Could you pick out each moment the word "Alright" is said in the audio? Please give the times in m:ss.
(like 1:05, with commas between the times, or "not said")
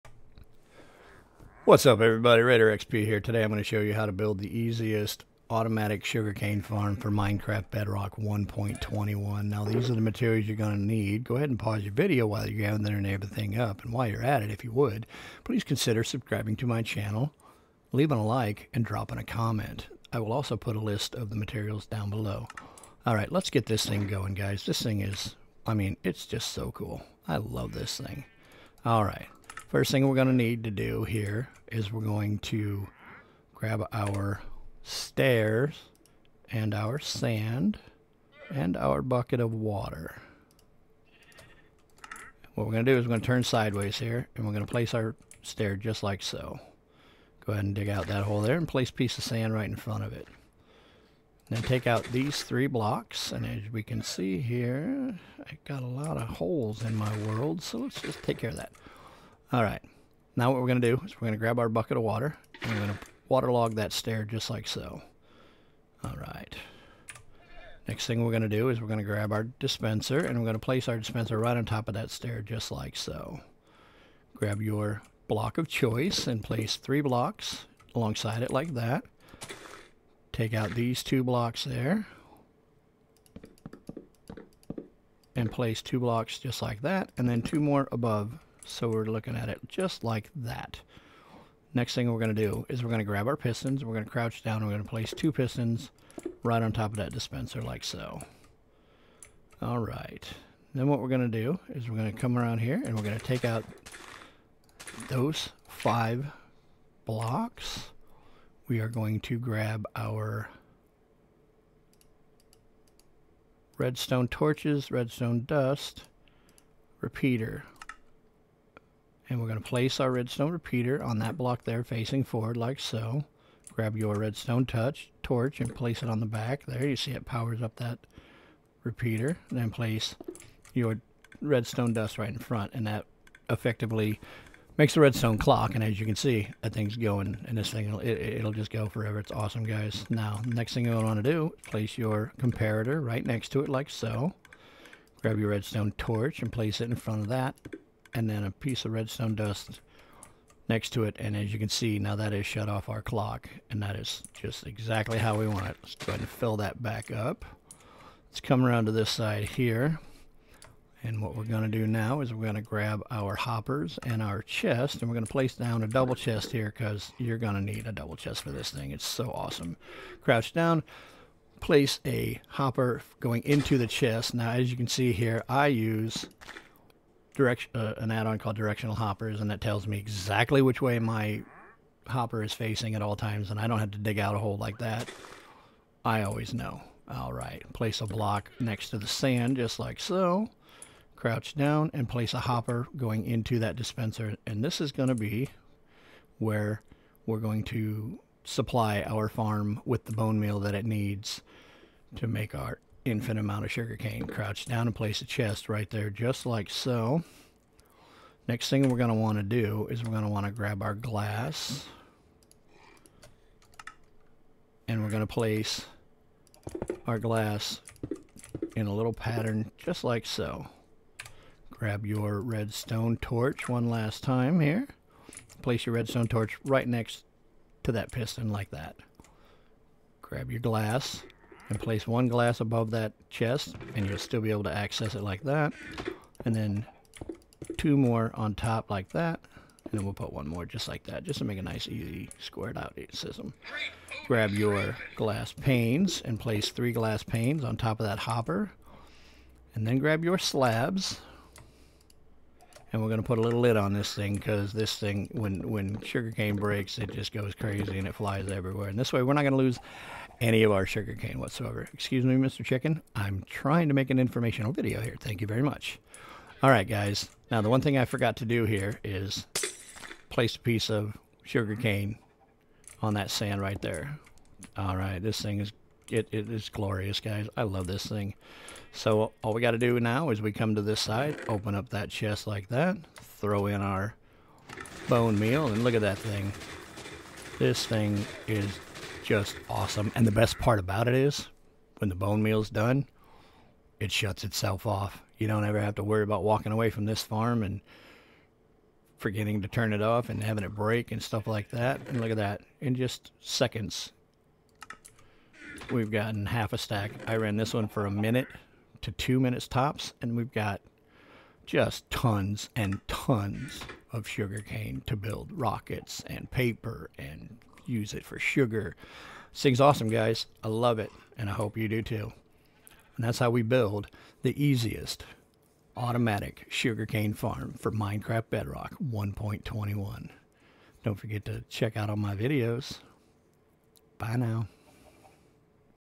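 0:23, 0:28.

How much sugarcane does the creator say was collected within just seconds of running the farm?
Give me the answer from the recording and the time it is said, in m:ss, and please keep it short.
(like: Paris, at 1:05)
half a stack, at 5:06.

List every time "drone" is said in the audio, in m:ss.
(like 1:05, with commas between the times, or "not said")
not said.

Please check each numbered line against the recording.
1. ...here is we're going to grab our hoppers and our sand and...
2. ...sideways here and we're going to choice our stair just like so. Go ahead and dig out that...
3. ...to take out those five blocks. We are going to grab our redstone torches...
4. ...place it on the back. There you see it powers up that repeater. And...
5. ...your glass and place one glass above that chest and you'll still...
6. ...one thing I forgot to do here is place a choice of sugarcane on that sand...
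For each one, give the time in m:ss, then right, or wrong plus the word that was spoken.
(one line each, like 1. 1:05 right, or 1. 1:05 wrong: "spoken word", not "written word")
1. 0:31 wrong: "stairs", not "hoppers"
2. 0:43 wrong: "place", not "choice"
3. 1:43 right
4. 2:05 right
5. 3:50 right
6. 4:27 wrong: "piece", not "choice".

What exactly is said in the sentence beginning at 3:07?
All right, place a block next to the sand just like so.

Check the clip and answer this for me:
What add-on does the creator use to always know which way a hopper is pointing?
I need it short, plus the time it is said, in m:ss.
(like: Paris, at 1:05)
directional hoppers, at 2:58.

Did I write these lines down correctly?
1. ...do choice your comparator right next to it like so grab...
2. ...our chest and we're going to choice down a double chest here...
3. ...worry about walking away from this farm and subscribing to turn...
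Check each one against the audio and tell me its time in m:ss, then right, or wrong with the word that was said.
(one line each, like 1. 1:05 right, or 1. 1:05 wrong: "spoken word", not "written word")
1. 2:21 wrong: "place", not "choice"
2. 2:44 wrong: "place", not "choice"
3. 4:56 wrong: "forgetting", not "subscribing".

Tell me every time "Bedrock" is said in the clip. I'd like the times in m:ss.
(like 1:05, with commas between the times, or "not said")
0:07, 5:28.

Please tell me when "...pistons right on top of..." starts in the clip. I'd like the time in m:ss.
1:35.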